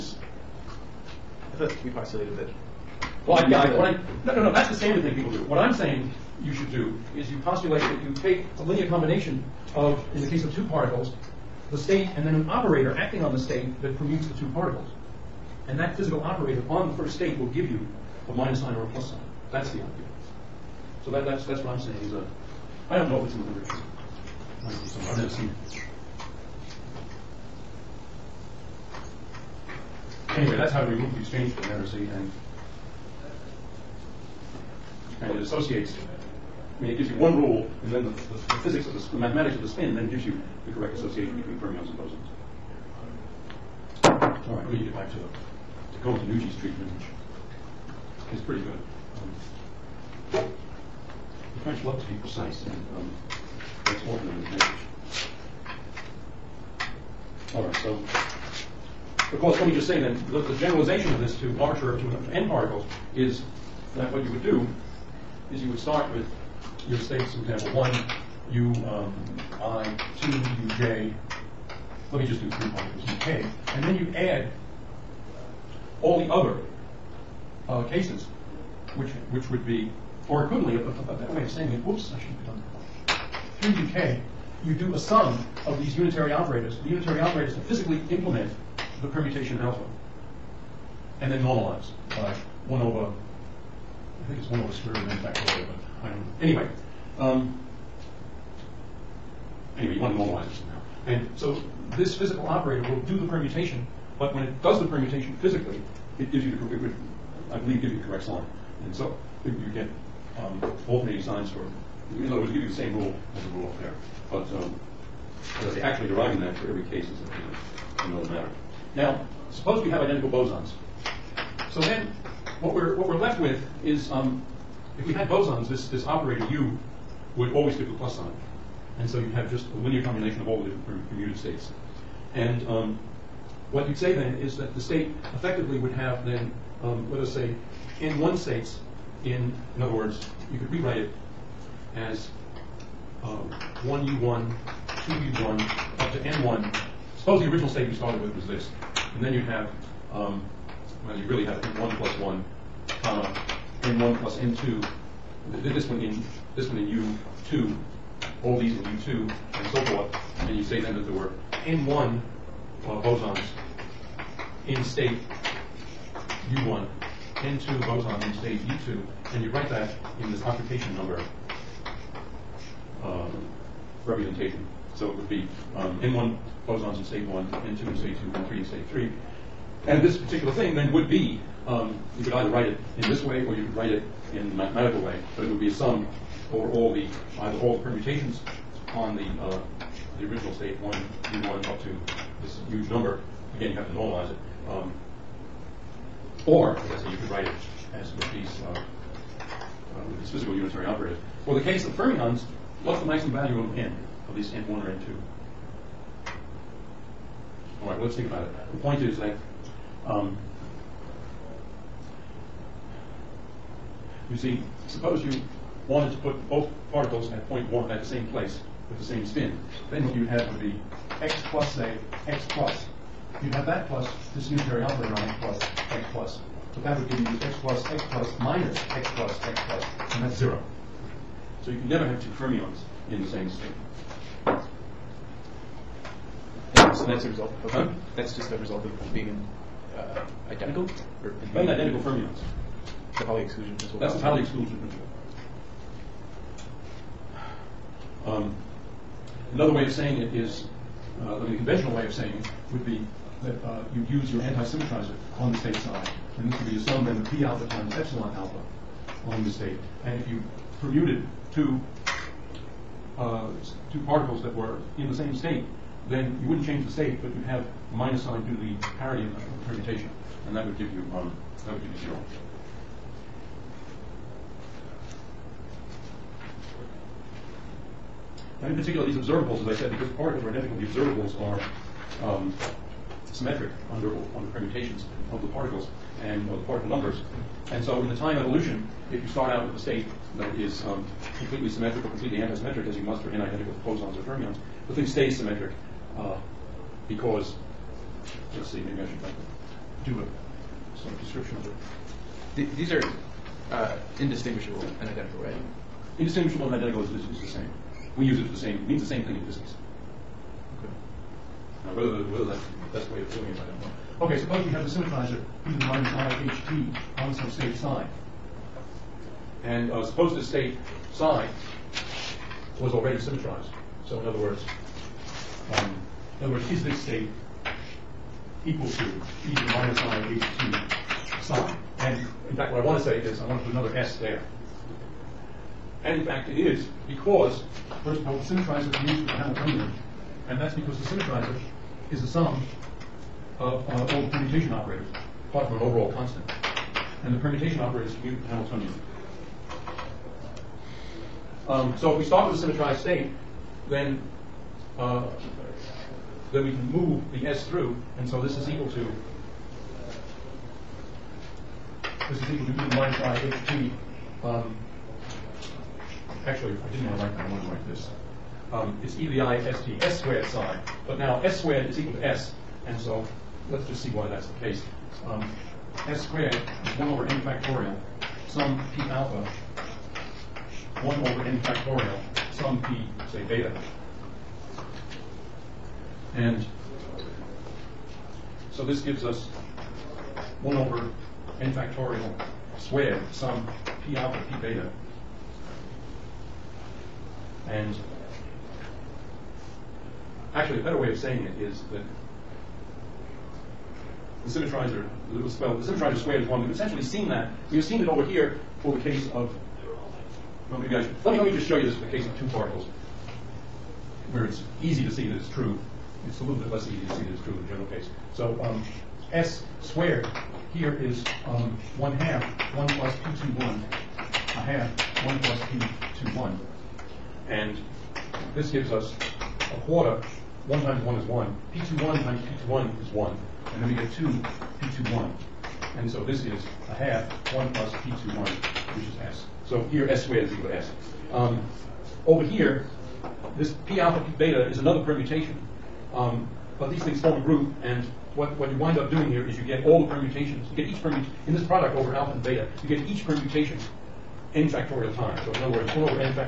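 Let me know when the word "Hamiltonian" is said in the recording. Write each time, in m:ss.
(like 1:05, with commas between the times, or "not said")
5:39, 5:48.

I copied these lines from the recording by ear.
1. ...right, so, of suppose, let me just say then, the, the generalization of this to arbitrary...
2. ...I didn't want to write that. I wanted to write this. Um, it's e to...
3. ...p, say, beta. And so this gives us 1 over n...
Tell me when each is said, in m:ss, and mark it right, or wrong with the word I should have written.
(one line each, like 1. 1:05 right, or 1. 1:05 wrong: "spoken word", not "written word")
1. 0:57 wrong: "course", not "suppose"
2. 6:06 right
3. 6:22 right.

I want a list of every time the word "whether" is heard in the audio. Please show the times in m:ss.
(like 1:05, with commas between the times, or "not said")
5:11.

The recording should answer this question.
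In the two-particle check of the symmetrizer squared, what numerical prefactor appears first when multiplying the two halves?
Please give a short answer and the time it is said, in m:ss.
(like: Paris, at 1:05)
a quarter, at 7:09.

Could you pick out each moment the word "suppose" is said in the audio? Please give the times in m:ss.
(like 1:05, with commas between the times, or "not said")
1:59, 2:27, 3:34, 5:14, 5:20.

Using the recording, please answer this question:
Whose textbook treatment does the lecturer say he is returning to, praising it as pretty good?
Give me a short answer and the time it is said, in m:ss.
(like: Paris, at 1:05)
Cohen-Tannoudji, at 0:46.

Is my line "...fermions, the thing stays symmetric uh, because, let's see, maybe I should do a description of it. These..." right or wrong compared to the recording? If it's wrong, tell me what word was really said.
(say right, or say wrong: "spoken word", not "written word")
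right.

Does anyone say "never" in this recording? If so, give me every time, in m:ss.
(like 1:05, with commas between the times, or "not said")
0:25, 3:51.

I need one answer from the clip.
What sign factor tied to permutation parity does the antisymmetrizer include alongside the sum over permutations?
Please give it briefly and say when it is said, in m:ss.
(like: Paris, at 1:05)
epsilon alpha, at 4:17.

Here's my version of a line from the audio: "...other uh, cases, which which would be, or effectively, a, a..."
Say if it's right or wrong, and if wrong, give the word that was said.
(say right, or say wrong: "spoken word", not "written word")
wrong: "equivalently", not "effectively".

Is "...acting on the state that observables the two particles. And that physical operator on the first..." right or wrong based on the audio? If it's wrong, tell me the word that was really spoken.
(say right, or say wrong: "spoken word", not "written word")
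wrong: "permutes", not "observables".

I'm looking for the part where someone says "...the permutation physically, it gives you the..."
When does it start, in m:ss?
1:44.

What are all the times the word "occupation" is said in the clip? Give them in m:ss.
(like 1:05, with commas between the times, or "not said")
2:50.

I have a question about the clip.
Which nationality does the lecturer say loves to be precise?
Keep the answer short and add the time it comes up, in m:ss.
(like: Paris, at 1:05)
French, at 0:51.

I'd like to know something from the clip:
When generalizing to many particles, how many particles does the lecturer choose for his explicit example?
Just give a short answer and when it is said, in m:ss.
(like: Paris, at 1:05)
3, at 1:12.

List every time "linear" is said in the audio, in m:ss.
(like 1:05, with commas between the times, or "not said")
0:08, 2:09.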